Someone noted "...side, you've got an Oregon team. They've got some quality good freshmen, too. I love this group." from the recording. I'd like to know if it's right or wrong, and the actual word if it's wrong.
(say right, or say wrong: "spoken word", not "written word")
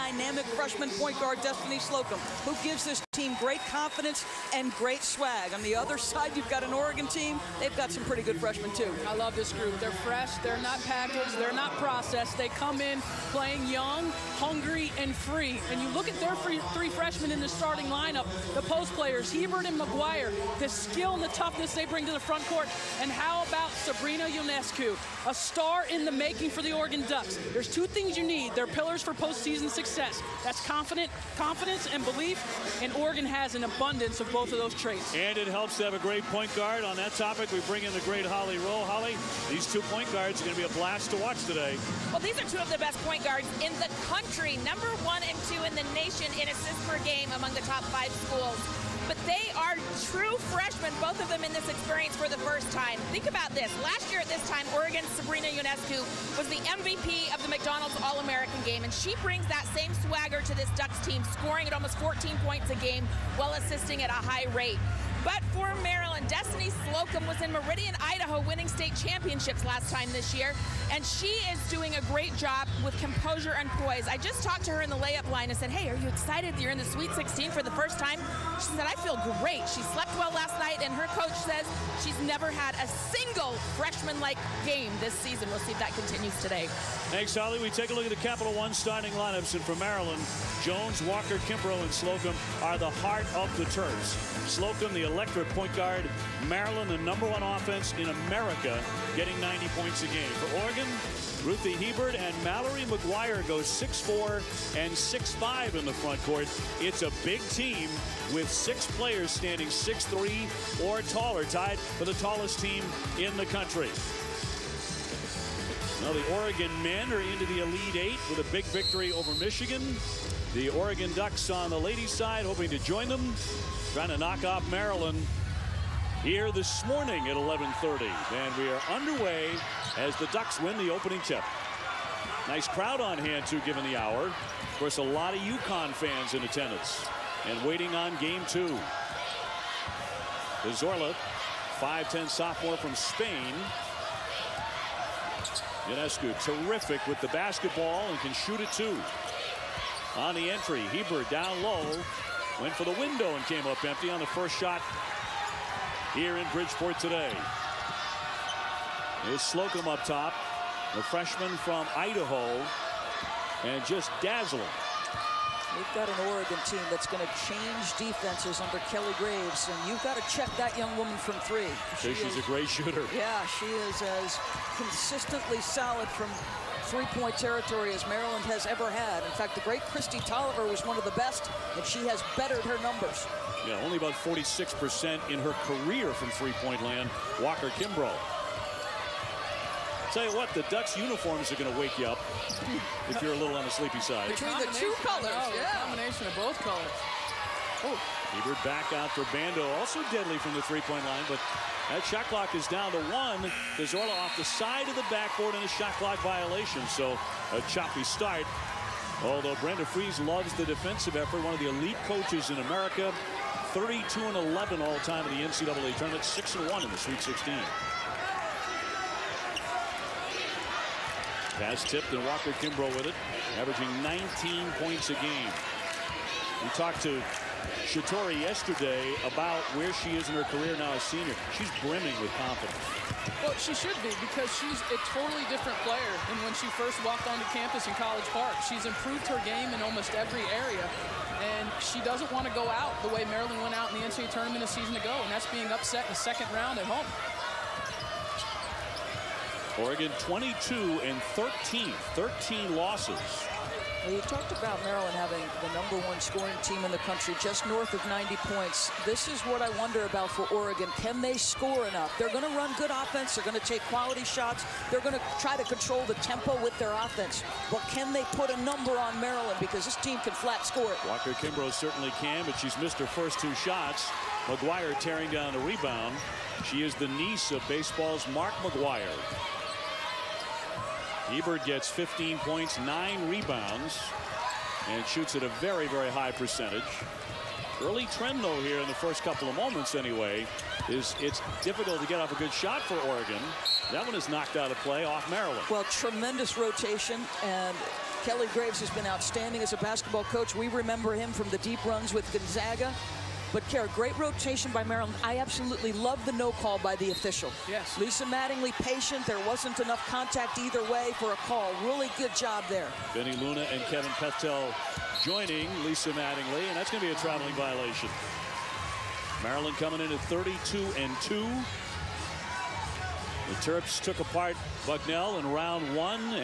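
wrong: "pretty", not "quality".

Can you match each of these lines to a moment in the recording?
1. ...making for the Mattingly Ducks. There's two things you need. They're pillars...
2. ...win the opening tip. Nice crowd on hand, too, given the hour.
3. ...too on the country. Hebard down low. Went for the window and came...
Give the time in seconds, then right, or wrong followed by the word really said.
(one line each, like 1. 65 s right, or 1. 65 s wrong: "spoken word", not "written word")
1. 26 s wrong: "Oregon", not "Mattingly"
2. 130 s right
3. 148 s wrong: "entry", not "country".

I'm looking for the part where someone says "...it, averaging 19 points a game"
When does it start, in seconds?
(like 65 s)
223 s.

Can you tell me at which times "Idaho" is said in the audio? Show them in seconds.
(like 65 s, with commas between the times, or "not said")
68 s, 161 s.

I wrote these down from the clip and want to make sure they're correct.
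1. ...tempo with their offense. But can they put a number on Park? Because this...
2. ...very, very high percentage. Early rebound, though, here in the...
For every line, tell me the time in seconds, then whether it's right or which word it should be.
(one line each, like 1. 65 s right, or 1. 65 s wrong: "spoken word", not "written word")
1. 266 s wrong: "Maryland", not "Park"
2. 285 s wrong: "trend", not "rebound".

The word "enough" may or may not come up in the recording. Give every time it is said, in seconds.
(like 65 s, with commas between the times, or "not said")
261 s, 309 s.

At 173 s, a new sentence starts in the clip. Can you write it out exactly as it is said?
Yeah, she is as consistently solid from three-point territory as Maryland has ever had.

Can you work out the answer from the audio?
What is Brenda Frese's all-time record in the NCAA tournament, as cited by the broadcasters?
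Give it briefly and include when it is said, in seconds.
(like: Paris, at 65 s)
32 and 11, at 213 s.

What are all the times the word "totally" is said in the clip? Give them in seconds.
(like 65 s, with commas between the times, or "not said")
235 s.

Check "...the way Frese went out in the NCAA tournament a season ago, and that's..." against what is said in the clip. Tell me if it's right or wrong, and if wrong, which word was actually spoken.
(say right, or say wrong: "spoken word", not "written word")
wrong: "Maryland", not "Frese".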